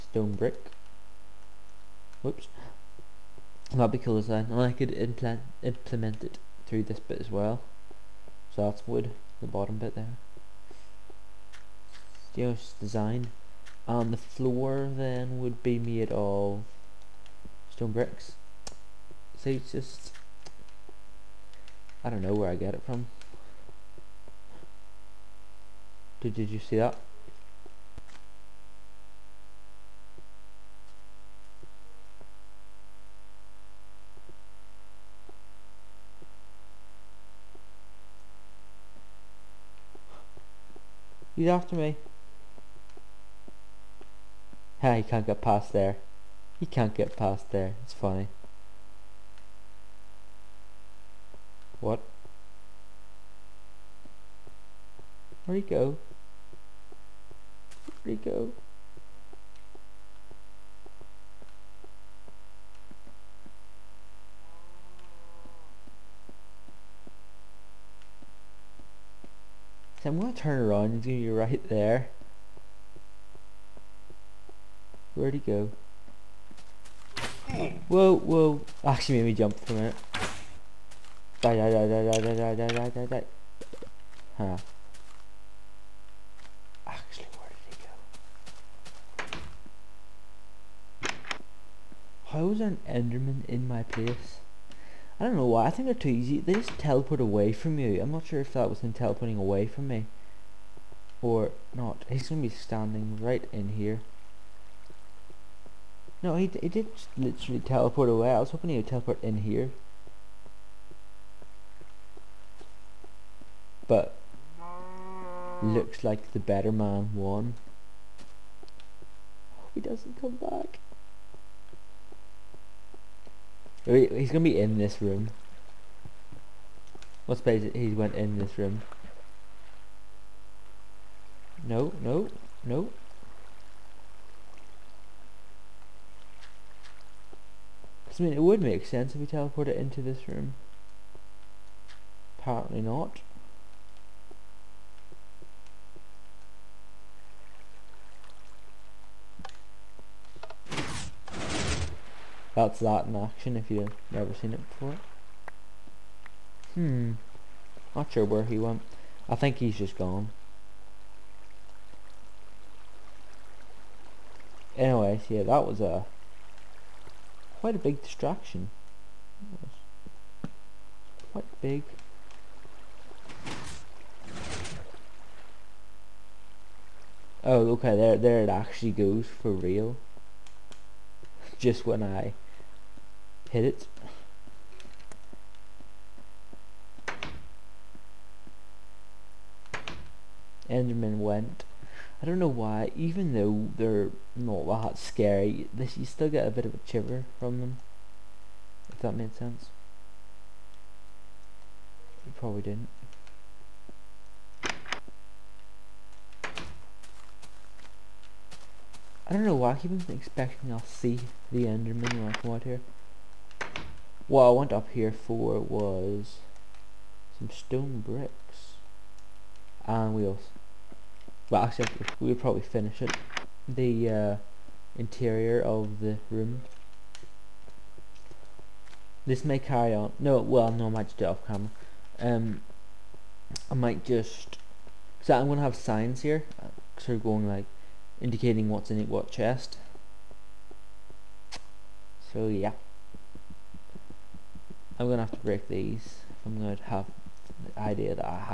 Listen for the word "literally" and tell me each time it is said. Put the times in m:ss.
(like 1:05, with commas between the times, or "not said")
1:47.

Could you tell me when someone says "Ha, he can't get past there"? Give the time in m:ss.
0:44.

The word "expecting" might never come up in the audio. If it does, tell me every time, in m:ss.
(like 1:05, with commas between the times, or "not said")
3:30.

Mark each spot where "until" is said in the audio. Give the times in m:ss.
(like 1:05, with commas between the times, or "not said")
not said.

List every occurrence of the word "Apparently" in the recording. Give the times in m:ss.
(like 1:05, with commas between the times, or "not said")
2:22.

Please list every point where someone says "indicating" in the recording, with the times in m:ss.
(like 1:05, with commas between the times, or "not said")
3:58.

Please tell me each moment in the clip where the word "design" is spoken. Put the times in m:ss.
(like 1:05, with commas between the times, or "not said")
0:04, 0:12.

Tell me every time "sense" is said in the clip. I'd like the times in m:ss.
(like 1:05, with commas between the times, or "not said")
2:18, 3:19.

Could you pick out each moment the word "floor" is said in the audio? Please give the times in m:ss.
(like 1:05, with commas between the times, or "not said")
0:14.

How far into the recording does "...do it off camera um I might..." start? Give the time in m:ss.
3:51.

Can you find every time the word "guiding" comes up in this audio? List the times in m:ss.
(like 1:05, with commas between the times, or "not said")
not said.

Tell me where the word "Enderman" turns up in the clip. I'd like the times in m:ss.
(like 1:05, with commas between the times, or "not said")
1:32, 3:10, 3:31.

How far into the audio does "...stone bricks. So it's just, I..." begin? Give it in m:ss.
0:17.